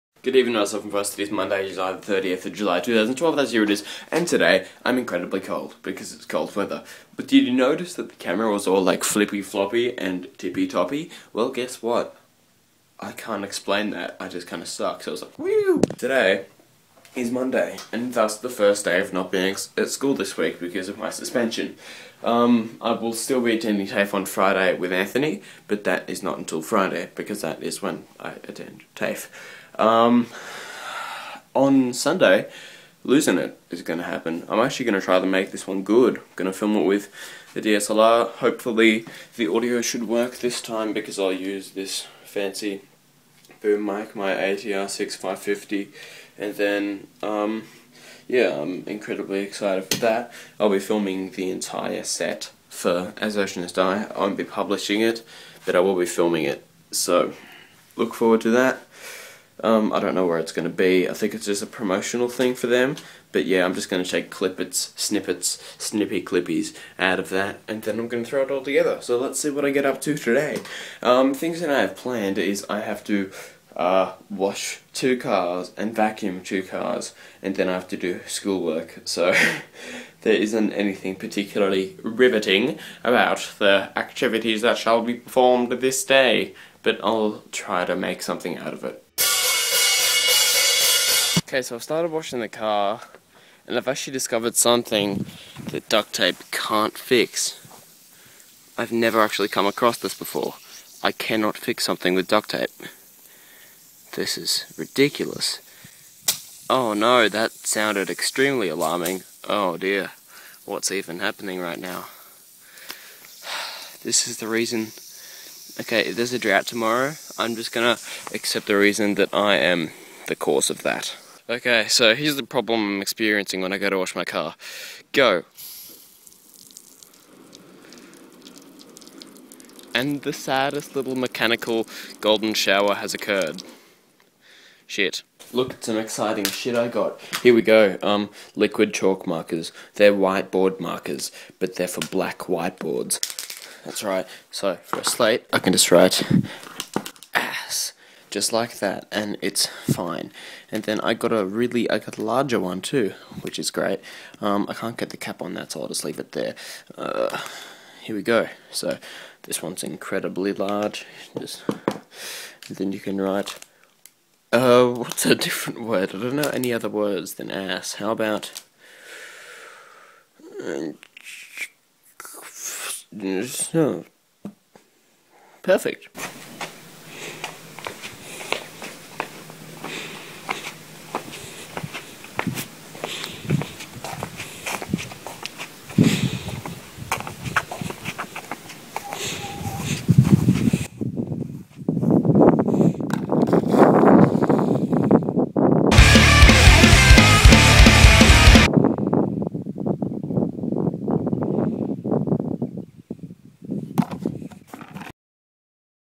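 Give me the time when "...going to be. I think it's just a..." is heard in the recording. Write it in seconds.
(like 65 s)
60 s.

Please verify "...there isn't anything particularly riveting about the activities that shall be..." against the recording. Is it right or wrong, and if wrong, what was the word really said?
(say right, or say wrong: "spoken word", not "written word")
right.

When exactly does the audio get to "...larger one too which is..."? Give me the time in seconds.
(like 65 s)
152 s.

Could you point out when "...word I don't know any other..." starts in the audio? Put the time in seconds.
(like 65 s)
165 s.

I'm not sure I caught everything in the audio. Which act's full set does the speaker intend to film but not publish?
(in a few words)
As Oceans Die.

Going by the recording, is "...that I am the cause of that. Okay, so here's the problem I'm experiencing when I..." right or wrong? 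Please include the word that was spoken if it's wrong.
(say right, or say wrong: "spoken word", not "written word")
right.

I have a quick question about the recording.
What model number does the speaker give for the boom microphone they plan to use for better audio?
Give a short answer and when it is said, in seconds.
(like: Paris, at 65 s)
ATR 6550, at 44 s.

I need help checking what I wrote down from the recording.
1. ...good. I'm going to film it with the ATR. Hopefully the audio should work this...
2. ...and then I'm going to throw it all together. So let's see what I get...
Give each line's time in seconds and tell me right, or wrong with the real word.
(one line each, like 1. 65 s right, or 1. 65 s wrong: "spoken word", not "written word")
1. 35 s wrong: "DSLR", not "ATR"
2. 67 s right.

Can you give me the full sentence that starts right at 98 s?
I've never actually come across this before.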